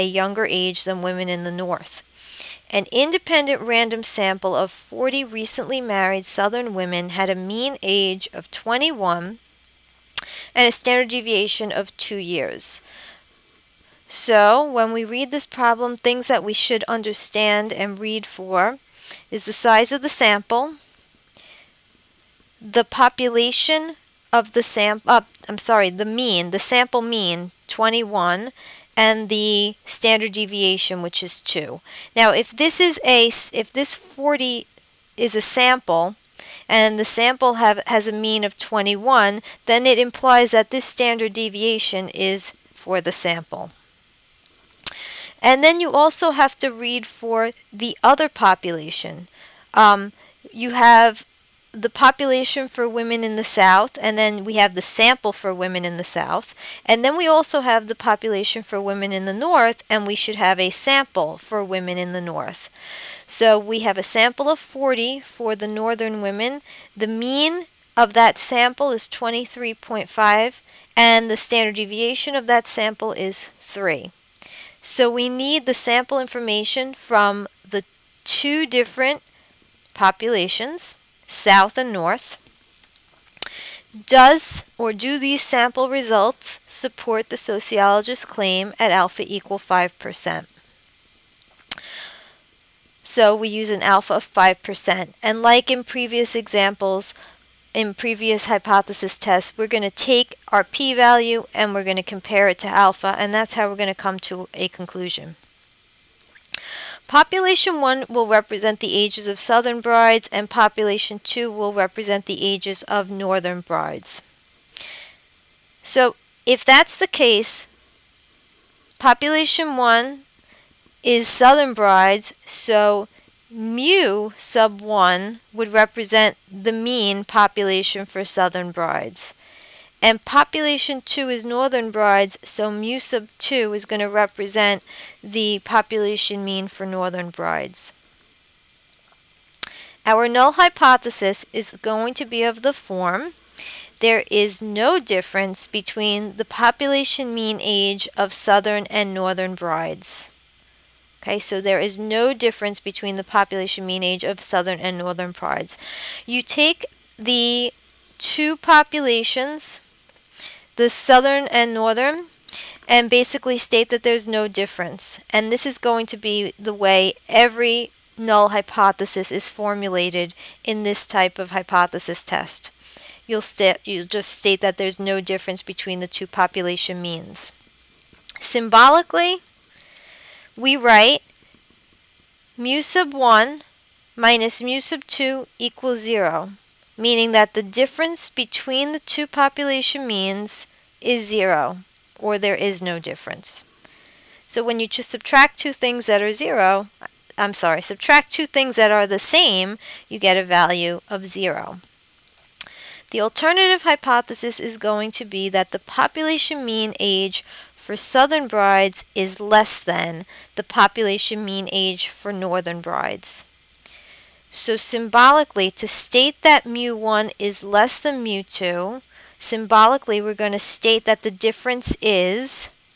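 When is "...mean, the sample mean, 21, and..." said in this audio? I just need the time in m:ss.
0:26.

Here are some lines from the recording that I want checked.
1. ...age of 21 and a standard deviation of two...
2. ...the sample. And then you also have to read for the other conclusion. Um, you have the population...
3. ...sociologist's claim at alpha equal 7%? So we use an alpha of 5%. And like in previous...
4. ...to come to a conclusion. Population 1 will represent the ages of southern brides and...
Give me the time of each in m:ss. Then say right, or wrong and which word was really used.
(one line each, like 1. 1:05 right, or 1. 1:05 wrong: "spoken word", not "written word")
1. 0:07 right
2. 0:42 wrong: "population", not "conclusion"
3. 1:27 wrong: "5", not "7"
4. 1:43 right.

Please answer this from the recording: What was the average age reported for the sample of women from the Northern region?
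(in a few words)
23.5.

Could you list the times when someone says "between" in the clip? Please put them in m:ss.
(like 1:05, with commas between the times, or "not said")
2:25, 2:32, 2:55, 3:08.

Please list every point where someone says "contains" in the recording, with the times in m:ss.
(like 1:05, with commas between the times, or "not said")
not said.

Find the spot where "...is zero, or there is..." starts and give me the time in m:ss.
3:10.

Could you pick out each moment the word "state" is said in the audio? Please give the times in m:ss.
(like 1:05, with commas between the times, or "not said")
2:43, 2:54, 3:35, 3:40.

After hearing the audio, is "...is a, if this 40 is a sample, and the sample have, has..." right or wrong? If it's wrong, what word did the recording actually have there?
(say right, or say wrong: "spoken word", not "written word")
right.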